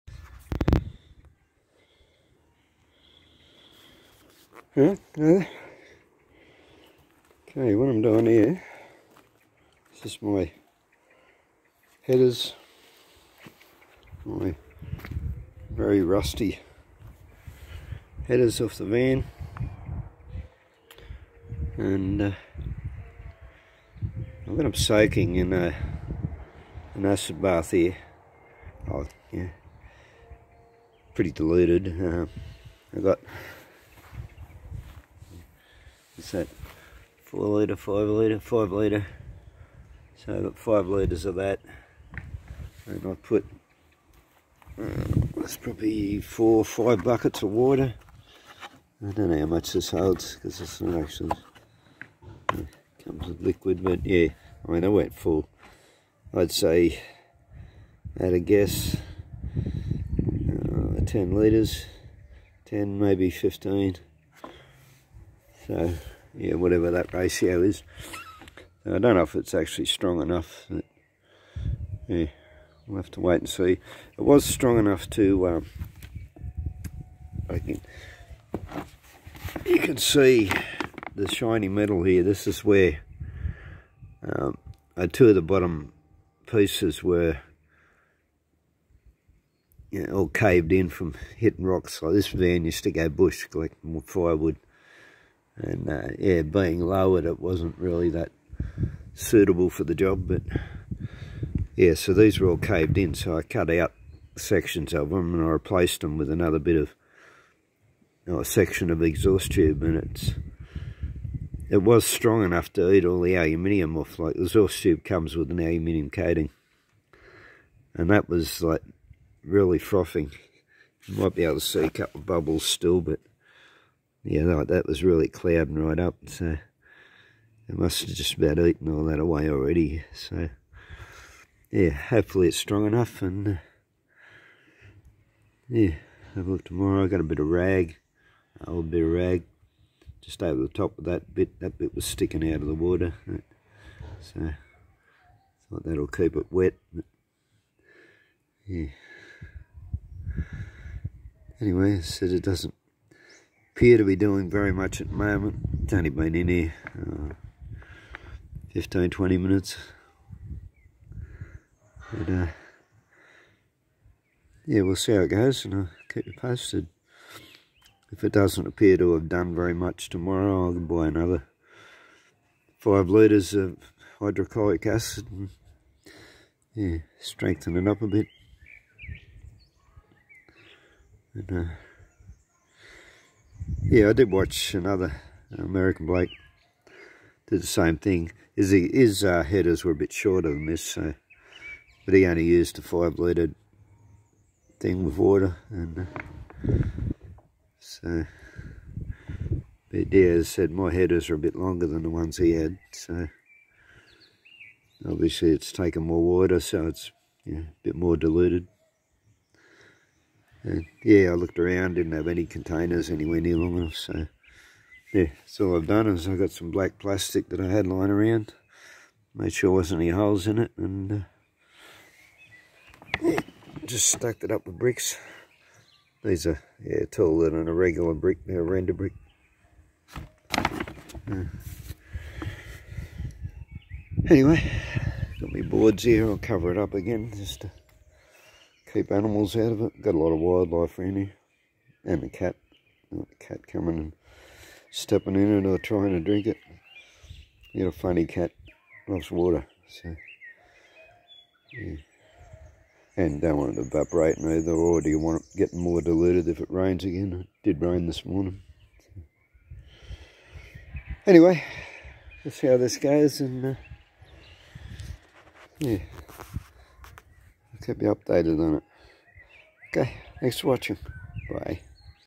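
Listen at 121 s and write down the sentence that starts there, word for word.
You might be able to see a couple of bubbles still, but yeah, that, that was really clouding right up.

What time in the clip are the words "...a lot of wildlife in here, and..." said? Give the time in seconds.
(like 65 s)
240 s.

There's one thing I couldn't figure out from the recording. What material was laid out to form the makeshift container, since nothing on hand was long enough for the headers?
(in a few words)
Black plastic.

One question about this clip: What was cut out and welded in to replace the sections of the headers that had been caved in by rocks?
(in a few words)
A section of exhaust tube.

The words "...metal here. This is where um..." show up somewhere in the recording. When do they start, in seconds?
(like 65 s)
81 s.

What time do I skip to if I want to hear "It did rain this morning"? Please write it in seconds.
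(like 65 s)
257 s.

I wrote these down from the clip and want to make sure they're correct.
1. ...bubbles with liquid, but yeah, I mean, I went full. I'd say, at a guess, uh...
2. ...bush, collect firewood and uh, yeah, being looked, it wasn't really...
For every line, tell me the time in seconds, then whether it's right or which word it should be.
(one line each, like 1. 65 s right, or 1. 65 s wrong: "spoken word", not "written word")
1. 53 s wrong: "comes", not "bubbles"
2. 93 s wrong: "lowered", not "looked".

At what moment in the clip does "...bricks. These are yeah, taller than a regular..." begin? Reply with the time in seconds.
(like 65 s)
224 s.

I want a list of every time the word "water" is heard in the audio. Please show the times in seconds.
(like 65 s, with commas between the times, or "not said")
47 s, 142 s, 195 s, 206 s, 249 s.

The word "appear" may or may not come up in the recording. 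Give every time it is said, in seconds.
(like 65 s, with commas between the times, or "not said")
153 s, 168 s.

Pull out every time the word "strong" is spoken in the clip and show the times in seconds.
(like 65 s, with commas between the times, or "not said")
69 s, 74 s, 112 s, 132 s.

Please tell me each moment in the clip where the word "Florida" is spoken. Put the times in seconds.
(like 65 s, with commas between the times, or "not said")
not said.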